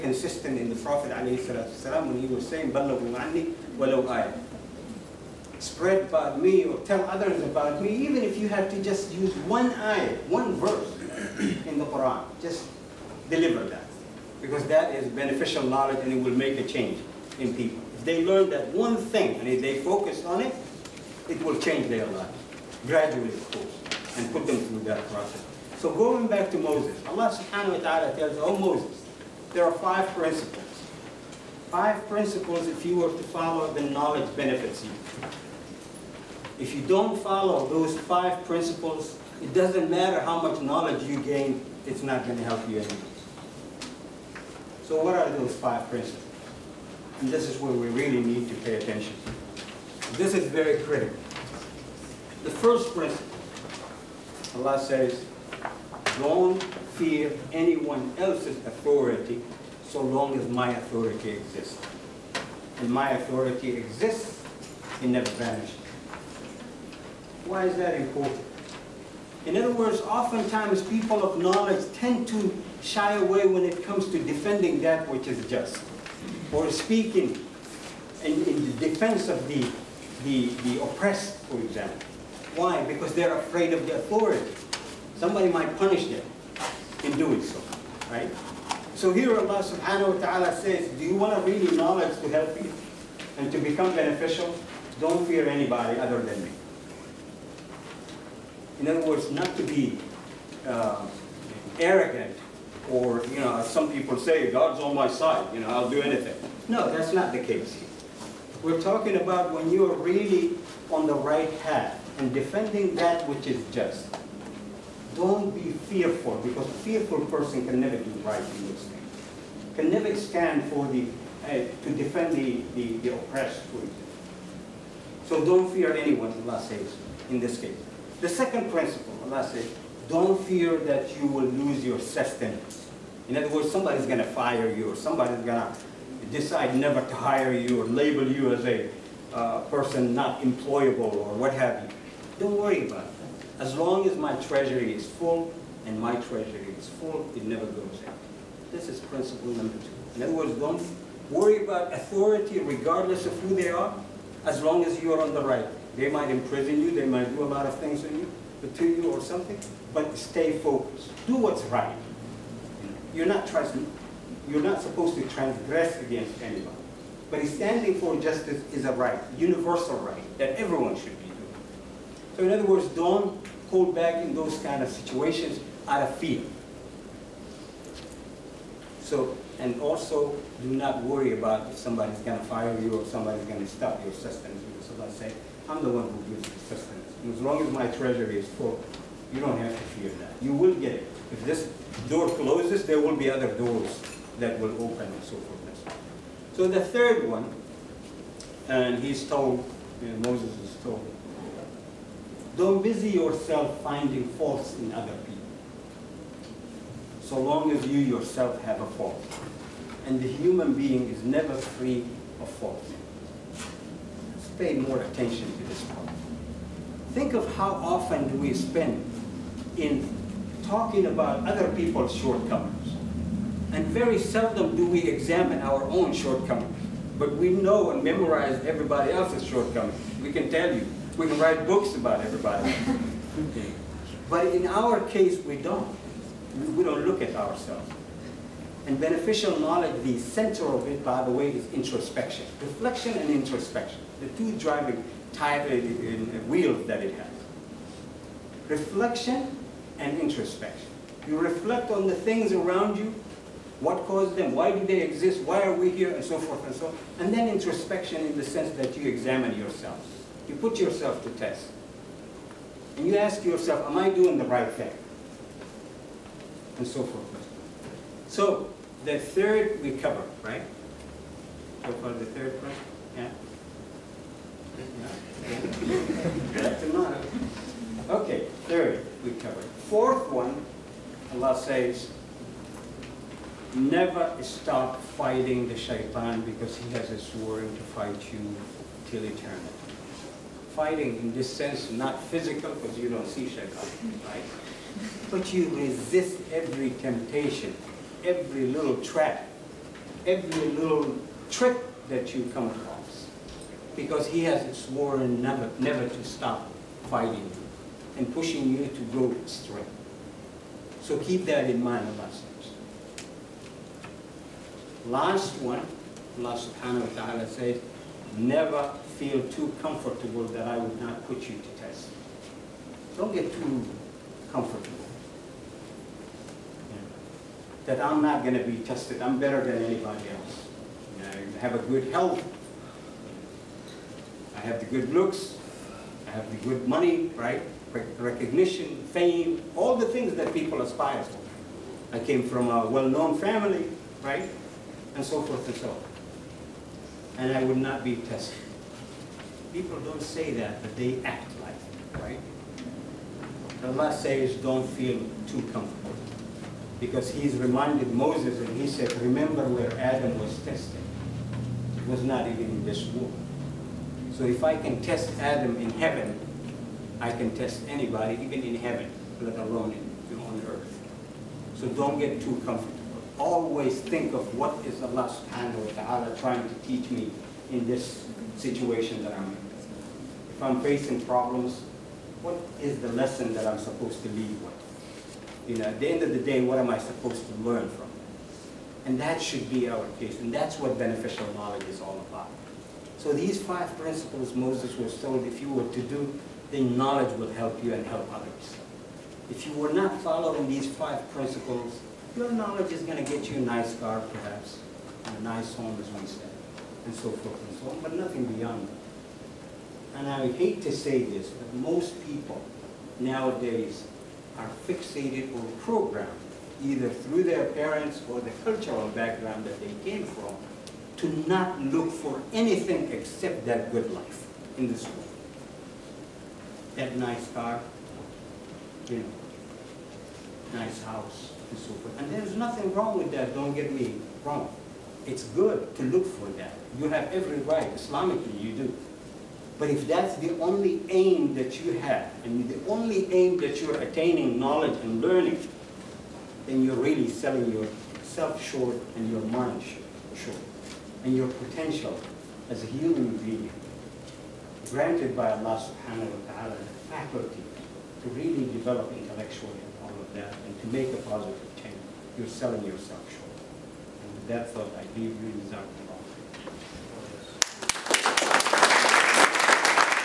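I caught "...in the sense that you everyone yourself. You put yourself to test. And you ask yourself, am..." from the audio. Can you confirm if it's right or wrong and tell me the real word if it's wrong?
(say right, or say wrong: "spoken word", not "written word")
wrong: "examine", not "everyone".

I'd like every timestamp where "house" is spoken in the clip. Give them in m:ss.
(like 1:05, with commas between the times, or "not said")
7:11.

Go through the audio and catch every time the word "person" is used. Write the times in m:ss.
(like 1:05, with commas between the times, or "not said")
1:57, 2:19.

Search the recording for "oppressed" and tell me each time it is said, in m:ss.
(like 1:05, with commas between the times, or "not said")
1:20, 2:03.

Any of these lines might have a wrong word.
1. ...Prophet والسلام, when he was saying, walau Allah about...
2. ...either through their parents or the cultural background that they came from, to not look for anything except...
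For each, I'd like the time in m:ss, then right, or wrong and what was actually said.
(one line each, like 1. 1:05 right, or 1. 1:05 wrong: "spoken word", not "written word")
1. 0:00 wrong: "Spread", not "Allah"
2. 6:56 right.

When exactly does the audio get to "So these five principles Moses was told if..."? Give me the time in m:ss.
6:33.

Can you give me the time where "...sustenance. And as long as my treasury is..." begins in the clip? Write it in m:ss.
3:06.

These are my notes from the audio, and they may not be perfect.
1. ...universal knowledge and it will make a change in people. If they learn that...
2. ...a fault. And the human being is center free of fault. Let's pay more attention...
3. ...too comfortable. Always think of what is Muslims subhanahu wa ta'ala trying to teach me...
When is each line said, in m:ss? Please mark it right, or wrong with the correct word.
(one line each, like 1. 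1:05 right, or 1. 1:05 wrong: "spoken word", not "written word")
1. 0:15 wrong: "beneficial", not "universal"
2. 3:28 wrong: "never", not "center"
3. 6:12 wrong: "Allah", not "Muslims".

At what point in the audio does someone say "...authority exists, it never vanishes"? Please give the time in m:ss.
1:03.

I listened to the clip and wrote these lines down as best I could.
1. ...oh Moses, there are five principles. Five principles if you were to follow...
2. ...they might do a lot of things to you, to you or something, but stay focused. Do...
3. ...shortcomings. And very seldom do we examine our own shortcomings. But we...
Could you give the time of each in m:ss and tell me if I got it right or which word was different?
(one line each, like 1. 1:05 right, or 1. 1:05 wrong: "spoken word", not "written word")
1. 0:28 right
2. 2:36 right
3. 3:42 right.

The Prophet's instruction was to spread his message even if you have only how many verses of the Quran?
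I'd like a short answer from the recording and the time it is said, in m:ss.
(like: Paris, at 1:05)
1, at 0:09.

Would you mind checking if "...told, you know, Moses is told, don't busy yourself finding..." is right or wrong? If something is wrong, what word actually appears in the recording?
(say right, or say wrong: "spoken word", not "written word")
right.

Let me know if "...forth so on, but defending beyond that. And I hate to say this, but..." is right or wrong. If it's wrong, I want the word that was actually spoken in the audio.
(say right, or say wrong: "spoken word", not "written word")
wrong: "nothing", not "defending".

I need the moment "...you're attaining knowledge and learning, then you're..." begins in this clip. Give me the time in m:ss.
7:23.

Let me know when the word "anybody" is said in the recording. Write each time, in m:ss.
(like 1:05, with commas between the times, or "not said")
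1:35, 2:46, 5:29, 6:07.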